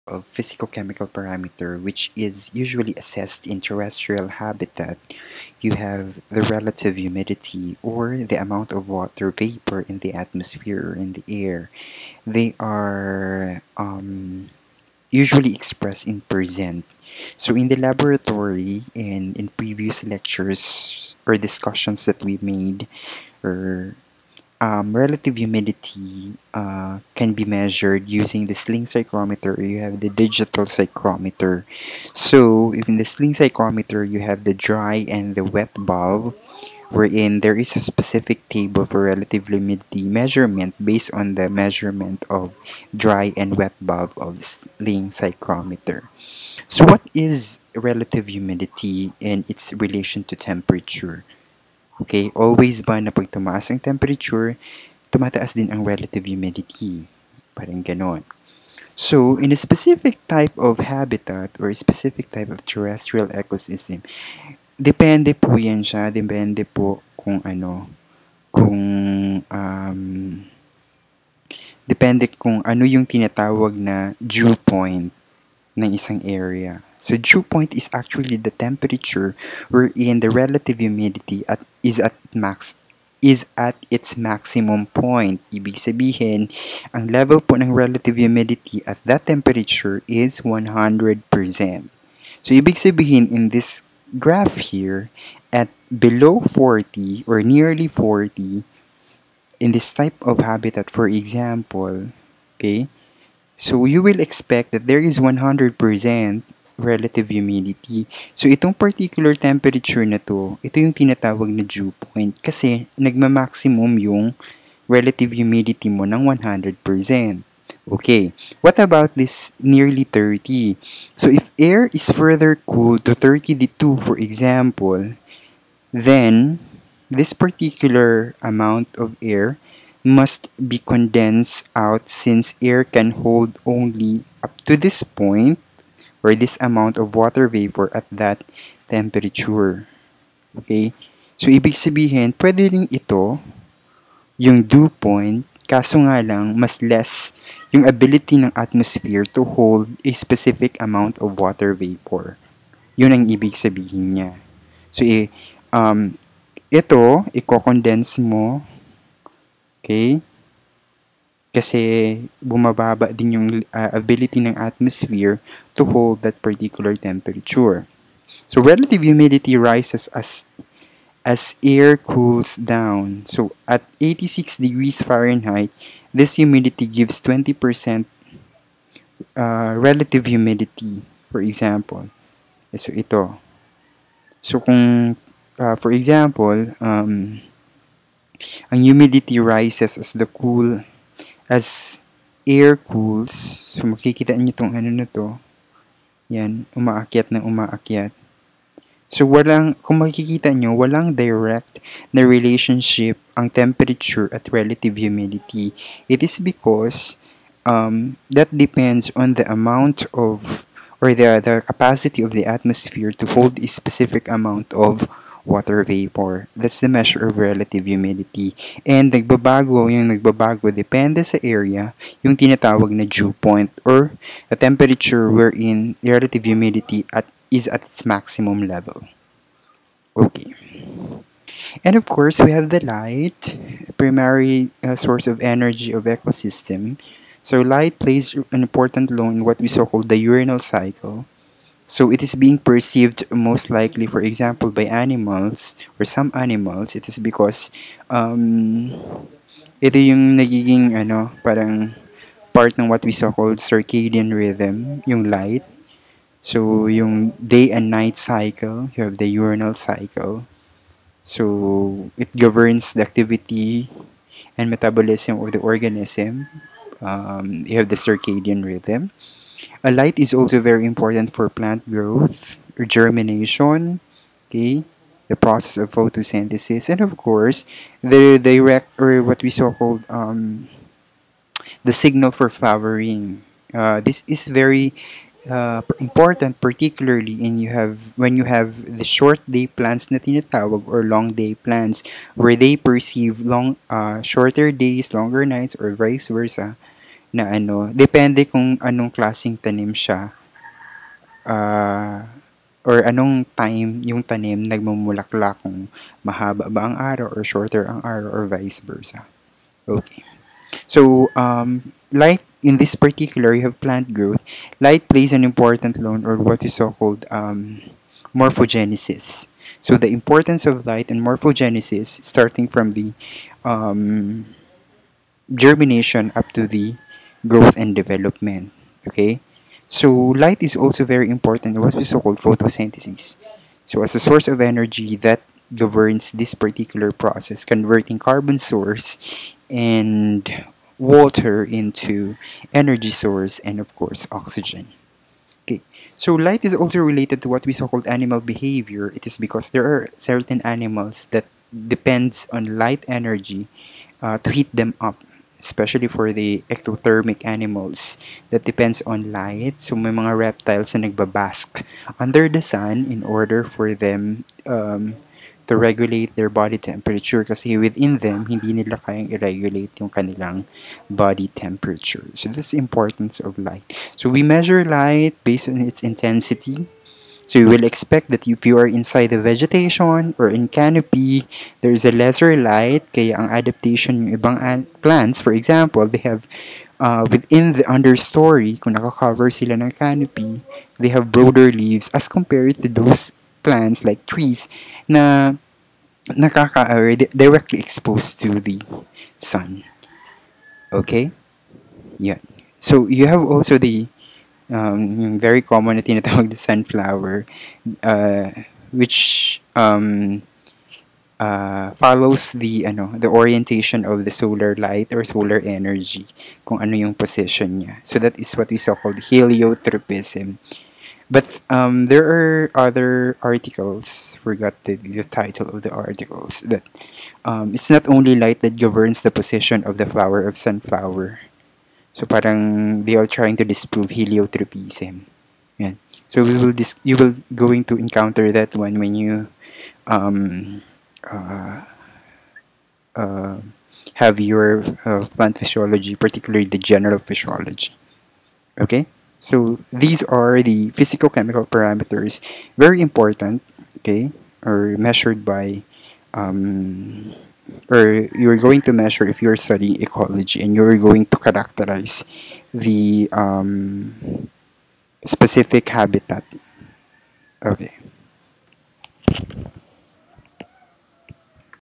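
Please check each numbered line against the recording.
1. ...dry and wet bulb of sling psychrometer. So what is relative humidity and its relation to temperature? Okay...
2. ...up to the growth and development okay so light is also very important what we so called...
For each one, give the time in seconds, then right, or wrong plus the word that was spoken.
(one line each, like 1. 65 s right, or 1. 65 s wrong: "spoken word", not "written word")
1. 42 s right
2. 326 s right.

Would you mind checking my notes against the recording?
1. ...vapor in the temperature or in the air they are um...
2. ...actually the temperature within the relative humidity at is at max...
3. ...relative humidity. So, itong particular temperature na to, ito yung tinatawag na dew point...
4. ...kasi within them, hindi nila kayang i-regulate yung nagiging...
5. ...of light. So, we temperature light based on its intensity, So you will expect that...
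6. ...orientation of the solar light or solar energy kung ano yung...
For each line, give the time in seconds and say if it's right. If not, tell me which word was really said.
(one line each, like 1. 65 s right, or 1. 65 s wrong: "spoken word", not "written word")
1. 9 s wrong: "atmosphere", not "temperature"
2. 77 s wrong: "wherein", not "within"
3. 106 s right
4. 367 s wrong: "kanilang", not "nagiging"
5. 373 s wrong: "measure", not "temperature"
6. 413 s right.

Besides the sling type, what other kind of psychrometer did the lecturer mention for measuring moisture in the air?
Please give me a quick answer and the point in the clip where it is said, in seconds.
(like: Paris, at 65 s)
digital psychrometer, at 30 s.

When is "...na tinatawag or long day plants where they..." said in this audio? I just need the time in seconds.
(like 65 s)
290 s.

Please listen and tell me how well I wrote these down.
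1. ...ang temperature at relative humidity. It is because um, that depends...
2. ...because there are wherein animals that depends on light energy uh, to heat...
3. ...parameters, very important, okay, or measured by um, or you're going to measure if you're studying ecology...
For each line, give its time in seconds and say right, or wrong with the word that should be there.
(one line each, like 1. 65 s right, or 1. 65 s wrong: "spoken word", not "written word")
1. 203 s right
2. 349 s wrong: "certain", not "wherein"
3. 451 s right.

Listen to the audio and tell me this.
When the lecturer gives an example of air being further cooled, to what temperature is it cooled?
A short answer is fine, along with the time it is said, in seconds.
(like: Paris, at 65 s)
32, at 123 s.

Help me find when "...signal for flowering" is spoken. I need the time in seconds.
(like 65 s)
281 s.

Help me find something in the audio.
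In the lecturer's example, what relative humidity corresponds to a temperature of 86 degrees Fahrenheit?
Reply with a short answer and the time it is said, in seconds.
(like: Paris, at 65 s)
20%, at 177 s.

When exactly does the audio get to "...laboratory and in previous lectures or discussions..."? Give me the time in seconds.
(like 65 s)
17 s.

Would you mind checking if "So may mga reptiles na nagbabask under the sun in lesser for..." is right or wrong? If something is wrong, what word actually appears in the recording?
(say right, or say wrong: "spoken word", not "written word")
wrong: "order", not "lesser".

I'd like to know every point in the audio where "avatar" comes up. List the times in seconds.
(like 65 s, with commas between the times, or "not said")
not said.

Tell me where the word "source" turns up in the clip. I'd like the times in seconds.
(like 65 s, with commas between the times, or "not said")
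234 s, 334 s, 338 s, 343 s.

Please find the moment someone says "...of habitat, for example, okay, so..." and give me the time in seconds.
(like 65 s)
100 s.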